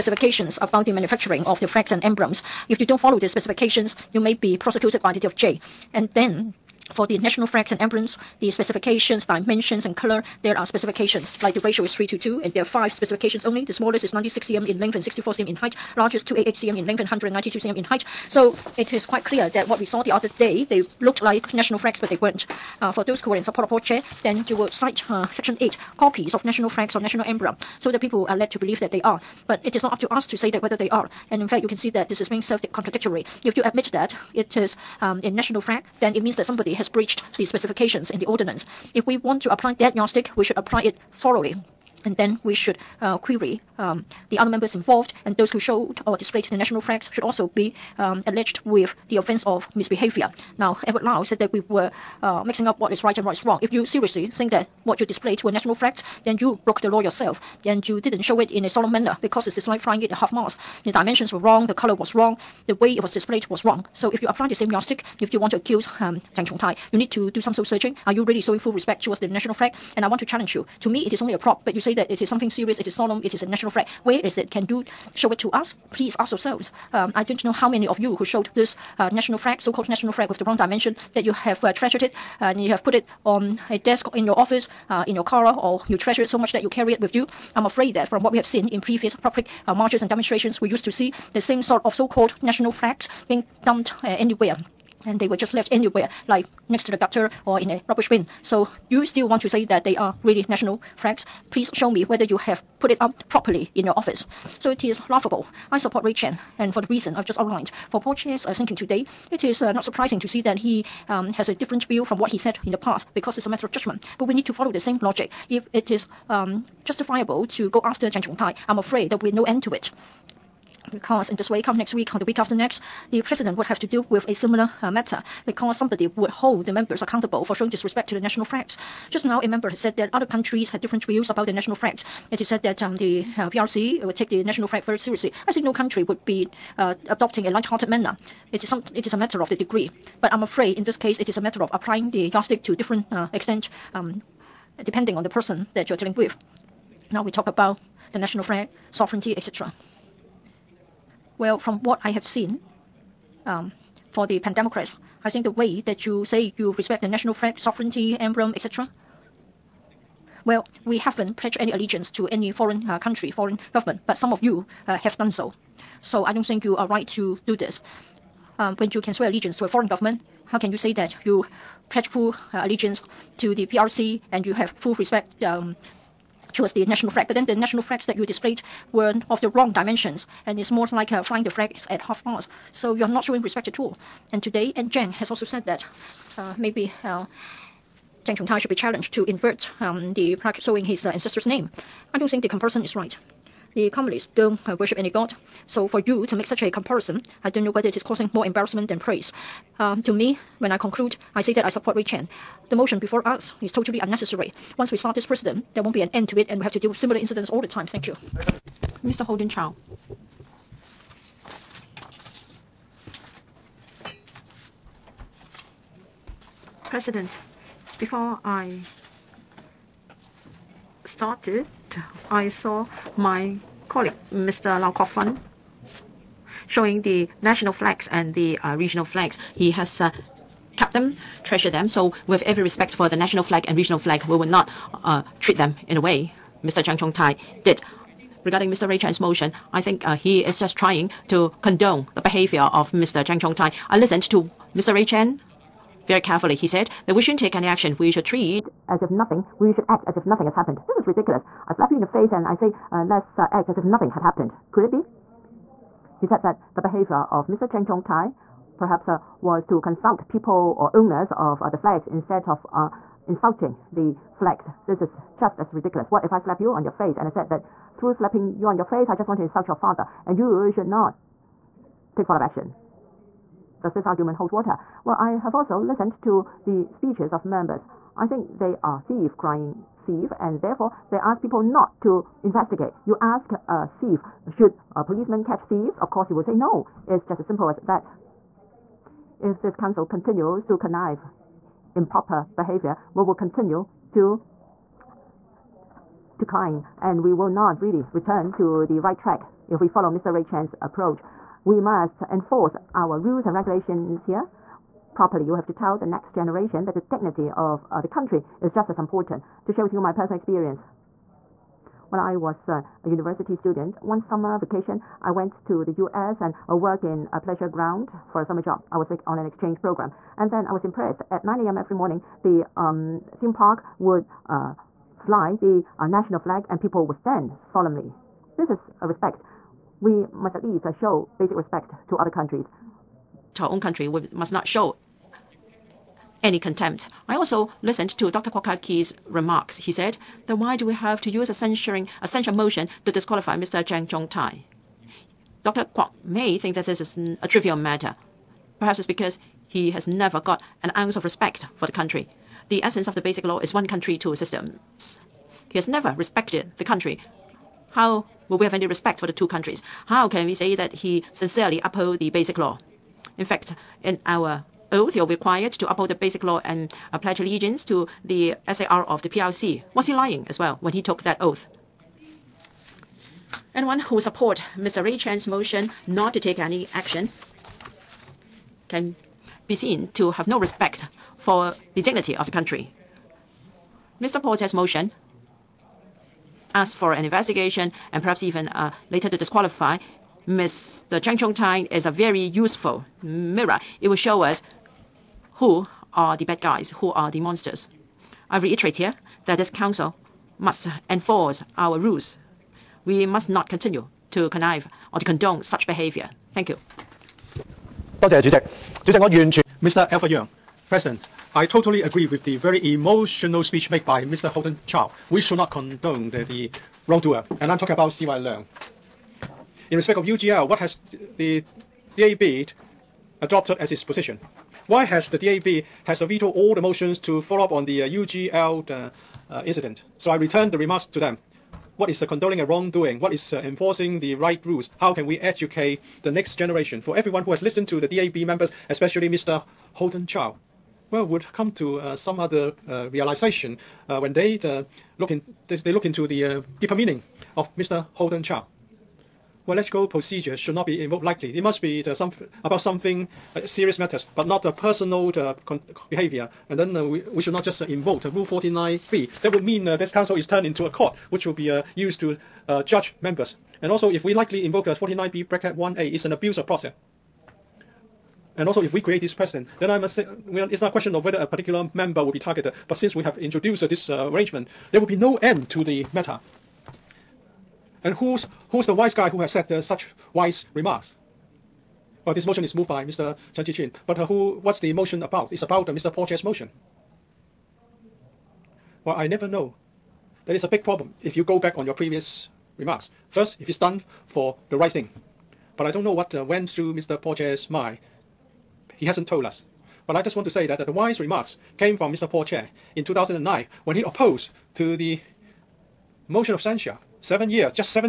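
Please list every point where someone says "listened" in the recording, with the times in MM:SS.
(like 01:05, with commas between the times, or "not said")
04:03, 04:35, 05:37, 07:17.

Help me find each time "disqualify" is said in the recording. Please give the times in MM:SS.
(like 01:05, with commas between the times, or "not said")
05:43, 06:29.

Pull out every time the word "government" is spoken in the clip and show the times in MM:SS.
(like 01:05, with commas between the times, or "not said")
02:43, 02:49.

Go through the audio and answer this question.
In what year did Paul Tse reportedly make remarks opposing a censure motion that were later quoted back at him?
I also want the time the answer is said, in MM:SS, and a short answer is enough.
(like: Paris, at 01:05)
2009, at 08:23.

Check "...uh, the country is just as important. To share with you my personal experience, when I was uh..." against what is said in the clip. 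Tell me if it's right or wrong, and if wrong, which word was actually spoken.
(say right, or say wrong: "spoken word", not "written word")
right.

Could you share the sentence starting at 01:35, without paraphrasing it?
And they were just left anywhere, like next to the gutter or in a rubbish bin.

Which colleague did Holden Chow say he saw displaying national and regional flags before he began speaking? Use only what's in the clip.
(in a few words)
Lau Kwok-fan.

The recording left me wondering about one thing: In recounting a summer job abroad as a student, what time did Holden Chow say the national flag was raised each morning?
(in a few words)
9 a.m.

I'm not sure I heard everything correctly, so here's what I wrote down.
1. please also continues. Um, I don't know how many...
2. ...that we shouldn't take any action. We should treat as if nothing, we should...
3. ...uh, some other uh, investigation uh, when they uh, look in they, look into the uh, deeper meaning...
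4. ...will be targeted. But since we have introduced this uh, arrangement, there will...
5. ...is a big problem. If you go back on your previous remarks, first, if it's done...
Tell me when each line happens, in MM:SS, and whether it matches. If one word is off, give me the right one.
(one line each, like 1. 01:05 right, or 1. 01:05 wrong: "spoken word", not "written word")
1. 01:15 wrong: "yourselves", not "continues"
2. 04:07 right
3. 07:21 wrong: "realization", not "investigation"
4. 07:52 right
5. 08:10 right.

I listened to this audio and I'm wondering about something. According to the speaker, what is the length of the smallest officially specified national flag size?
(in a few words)
96 cm.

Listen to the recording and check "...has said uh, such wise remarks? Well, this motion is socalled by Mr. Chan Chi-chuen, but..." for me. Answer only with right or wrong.
wrong.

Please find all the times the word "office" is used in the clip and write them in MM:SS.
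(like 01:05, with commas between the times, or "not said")
01:24, 01:43.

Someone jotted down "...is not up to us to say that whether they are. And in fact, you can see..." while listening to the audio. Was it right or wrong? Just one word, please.
right.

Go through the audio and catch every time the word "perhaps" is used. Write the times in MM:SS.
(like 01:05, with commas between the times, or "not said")
04:18, 05:48, 06:28.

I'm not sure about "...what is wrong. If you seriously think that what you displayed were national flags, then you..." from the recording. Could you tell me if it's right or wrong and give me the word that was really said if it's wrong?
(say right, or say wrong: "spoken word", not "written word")
right.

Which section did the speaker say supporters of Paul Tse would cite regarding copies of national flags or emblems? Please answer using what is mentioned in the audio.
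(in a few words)
Section 8.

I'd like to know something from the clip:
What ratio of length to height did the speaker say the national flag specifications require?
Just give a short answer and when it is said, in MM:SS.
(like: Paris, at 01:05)
3 to 2, at 00:11.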